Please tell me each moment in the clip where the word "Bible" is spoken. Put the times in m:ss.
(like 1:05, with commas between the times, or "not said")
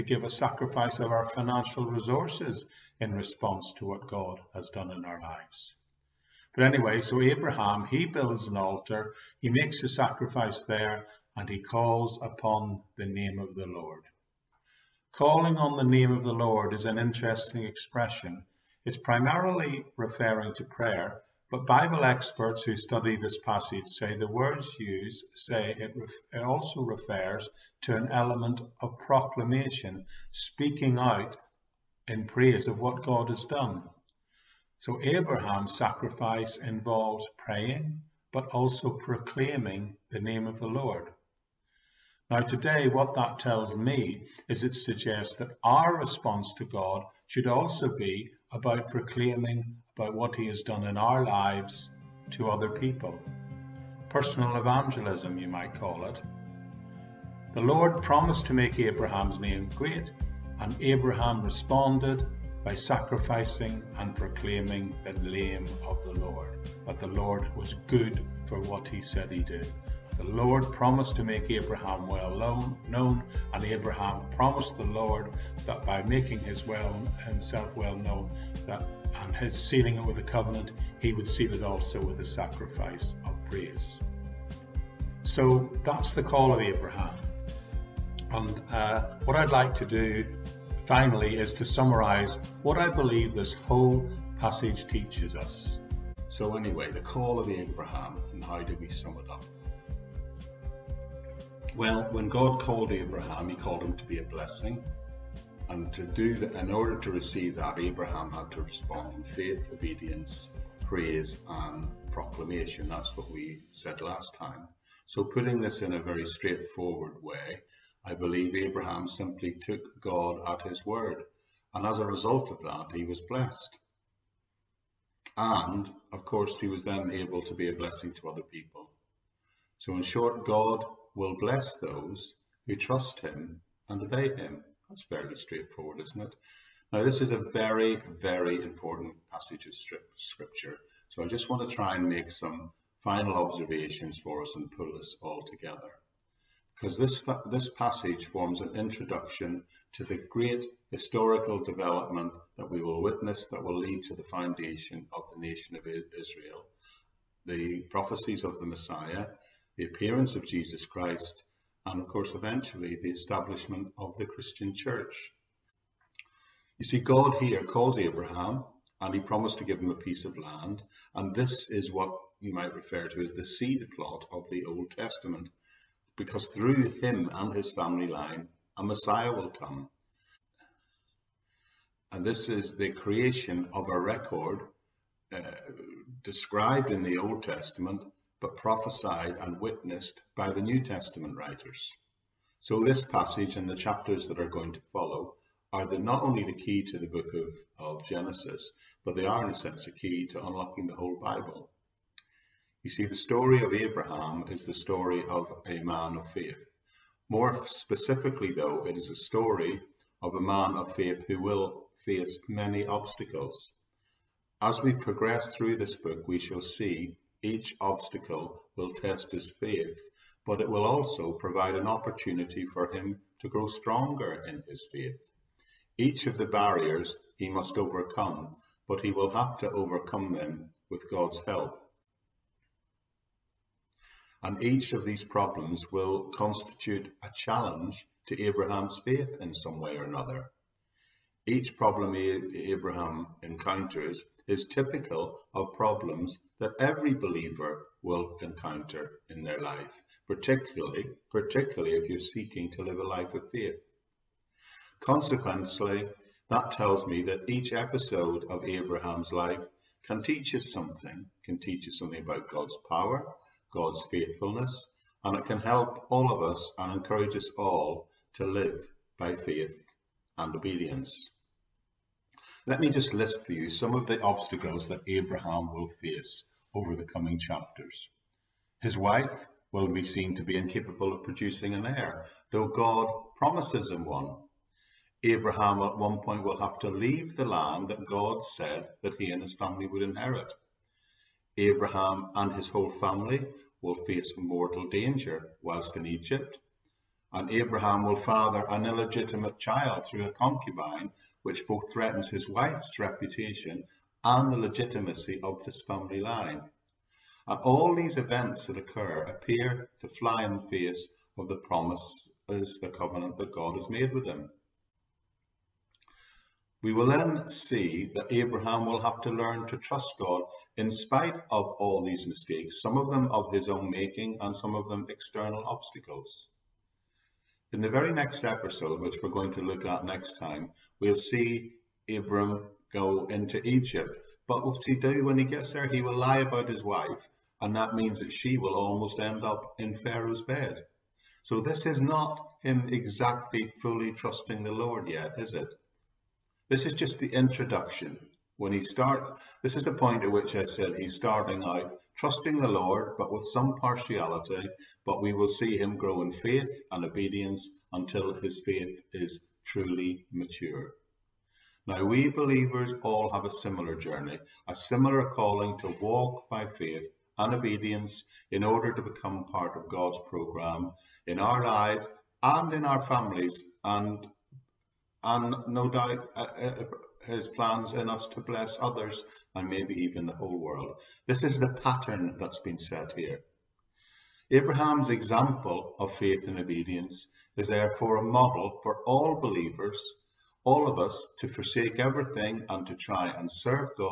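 0:21, 3:21.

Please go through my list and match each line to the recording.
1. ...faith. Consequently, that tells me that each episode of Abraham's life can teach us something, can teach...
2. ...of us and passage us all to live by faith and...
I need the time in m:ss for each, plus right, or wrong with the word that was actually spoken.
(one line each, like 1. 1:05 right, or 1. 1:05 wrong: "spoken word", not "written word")
1. 4:13 right
2. 4:26 wrong: "encourage", not "passage".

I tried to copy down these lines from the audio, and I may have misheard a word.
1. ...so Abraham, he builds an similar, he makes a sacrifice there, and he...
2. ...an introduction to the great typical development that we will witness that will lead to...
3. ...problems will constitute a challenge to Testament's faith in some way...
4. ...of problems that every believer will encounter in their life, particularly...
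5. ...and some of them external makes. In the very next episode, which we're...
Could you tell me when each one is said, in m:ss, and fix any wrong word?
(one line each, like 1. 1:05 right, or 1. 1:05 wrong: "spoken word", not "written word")
1. 0:07 wrong: "altar", not "similar"
2. 2:28 wrong: "historical", not "typical"
3. 3:55 wrong: "Abraham", not "Testament"
4. 4:05 right
5. 5:24 wrong: "obstacles", not "makes".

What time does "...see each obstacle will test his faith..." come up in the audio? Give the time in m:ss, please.
3:36.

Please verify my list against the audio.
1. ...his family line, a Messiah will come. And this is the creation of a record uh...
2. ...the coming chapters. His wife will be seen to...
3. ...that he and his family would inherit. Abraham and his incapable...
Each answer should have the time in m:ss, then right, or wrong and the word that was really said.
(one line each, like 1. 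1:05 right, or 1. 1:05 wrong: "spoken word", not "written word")
1. 2:57 right
2. 4:36 right
3. 4:49 wrong: "whole", not "incapable".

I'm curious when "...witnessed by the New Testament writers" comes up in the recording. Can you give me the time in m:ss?
3:09.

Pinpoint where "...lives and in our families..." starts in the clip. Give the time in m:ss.
6:11.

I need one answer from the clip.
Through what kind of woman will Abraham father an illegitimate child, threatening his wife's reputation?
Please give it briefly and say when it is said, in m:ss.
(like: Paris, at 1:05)
A concubine, at 5:00.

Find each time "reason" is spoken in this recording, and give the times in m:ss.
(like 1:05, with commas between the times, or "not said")
not said.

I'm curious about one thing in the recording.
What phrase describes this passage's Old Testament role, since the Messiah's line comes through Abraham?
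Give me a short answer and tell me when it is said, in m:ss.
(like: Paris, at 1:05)
seed plot, at 2:53.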